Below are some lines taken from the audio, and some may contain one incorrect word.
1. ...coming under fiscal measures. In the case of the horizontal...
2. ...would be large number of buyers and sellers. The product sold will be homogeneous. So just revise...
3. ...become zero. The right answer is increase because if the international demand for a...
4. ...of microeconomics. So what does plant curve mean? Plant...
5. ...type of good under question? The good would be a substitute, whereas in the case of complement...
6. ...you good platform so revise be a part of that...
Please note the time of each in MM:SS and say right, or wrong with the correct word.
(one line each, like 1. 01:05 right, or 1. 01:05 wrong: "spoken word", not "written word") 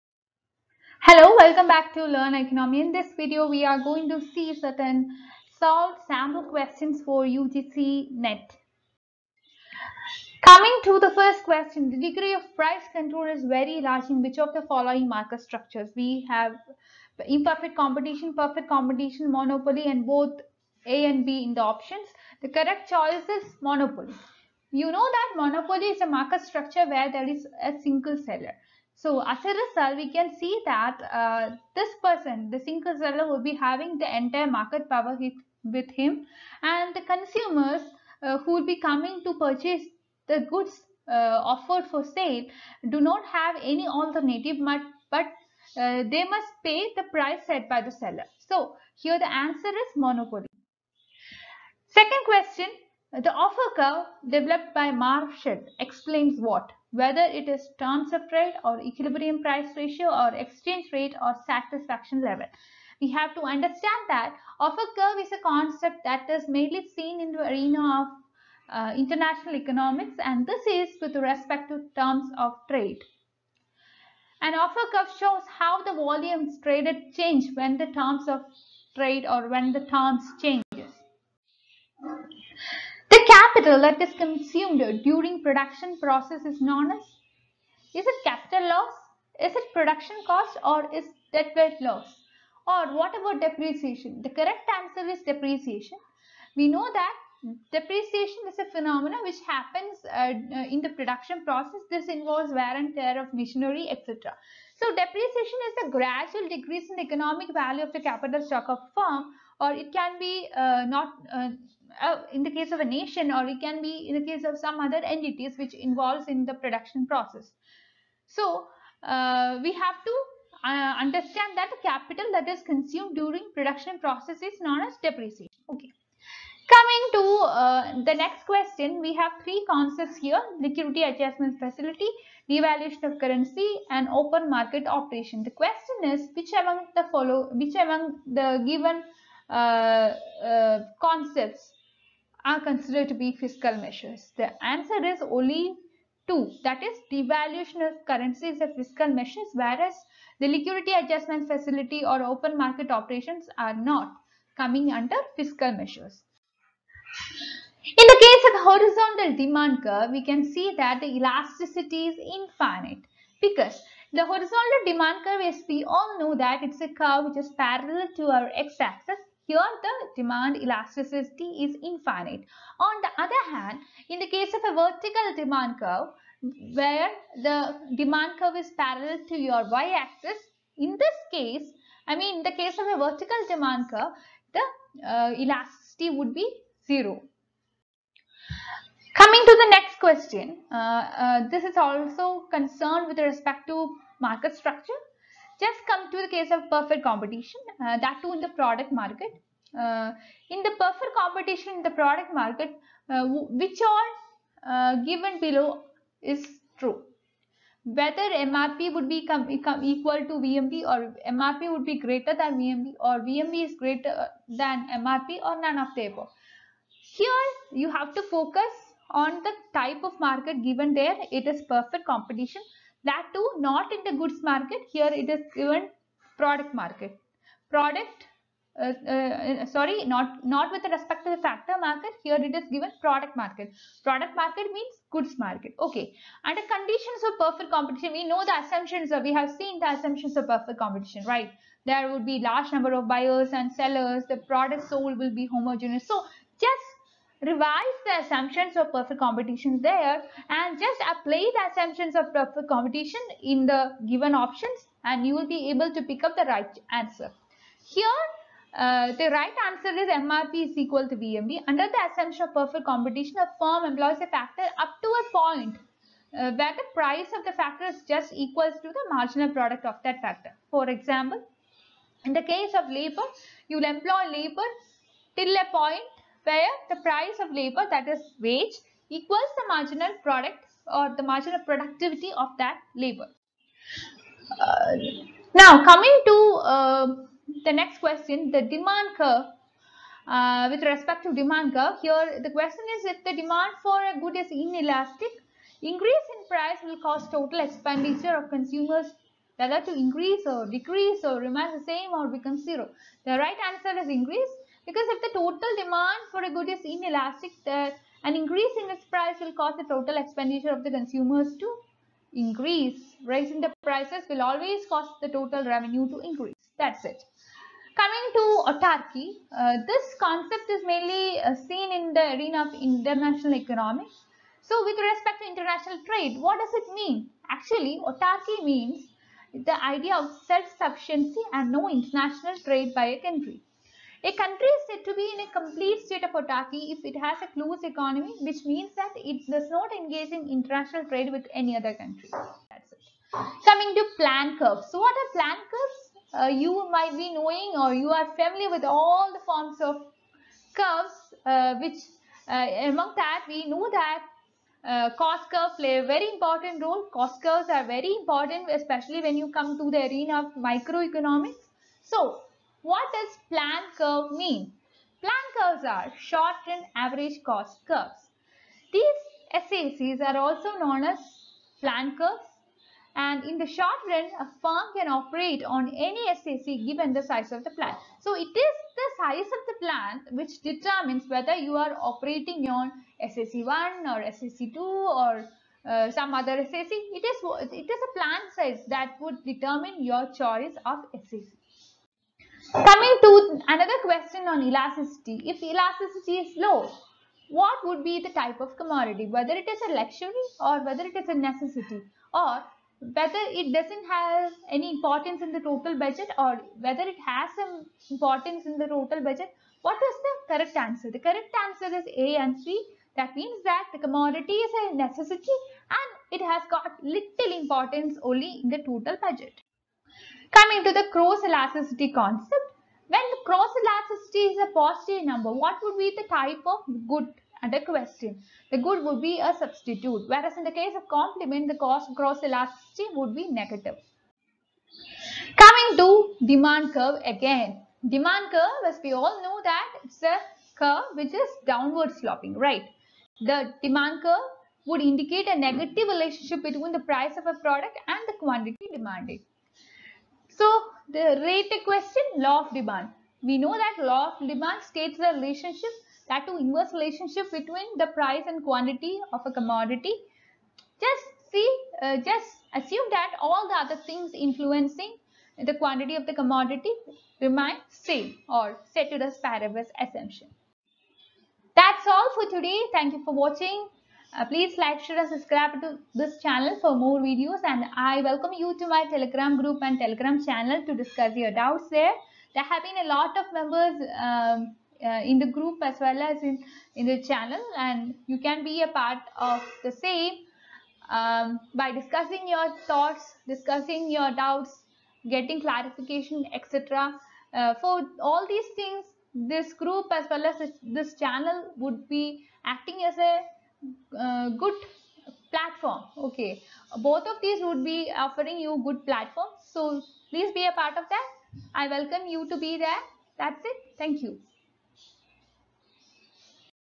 1. 02:34 right
2. 04:02 right
3. 05:02 wrong: "total", not "international"
4. 06:00 right
5. 07:06 right
6. 08:28 wrong: "please", not "revise".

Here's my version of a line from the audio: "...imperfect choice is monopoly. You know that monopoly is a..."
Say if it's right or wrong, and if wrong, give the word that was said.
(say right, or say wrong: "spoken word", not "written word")
wrong: "correct", not "imperfect".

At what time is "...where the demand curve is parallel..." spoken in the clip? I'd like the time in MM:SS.
02:56.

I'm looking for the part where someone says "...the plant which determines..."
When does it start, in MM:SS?
06:19.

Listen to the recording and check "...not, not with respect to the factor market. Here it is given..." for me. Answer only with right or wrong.
right.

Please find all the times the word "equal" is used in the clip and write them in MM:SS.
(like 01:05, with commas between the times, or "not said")
03:29, 04:20, 04:28, 04:39.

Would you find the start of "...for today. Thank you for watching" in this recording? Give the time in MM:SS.
07:52.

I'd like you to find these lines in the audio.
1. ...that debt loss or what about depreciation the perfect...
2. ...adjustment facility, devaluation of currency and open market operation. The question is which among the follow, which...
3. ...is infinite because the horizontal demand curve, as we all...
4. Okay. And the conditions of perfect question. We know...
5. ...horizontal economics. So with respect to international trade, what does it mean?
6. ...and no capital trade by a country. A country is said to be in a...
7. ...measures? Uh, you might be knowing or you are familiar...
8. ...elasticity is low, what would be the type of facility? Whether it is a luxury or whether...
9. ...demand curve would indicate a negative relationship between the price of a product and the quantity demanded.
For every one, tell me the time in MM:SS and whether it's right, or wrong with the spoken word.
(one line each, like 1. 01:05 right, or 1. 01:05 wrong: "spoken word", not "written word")
1. 01:31 wrong: "correct", not "perfect"
2. 02:11 right
3. 02:42 right
4. 03:55 wrong: "competition", not "question"
5. 05:22 wrong: "international", not "horizontal"
6. 05:31 wrong: "international", not "capital"
7. 05:45 wrong: "curves", not "measures"
8. 06:35 wrong: "commodity", not "facility"
9. 07:23 right.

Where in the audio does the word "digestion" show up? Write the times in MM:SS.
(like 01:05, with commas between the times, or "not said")
not said.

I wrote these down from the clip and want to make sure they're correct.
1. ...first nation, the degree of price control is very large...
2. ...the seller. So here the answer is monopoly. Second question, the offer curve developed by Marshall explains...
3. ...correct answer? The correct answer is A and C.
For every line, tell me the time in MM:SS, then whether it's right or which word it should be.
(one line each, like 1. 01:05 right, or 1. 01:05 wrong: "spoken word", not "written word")
1. 00:11 wrong: "question", not "nation"
2. 00:47 right
3. 06:50 right.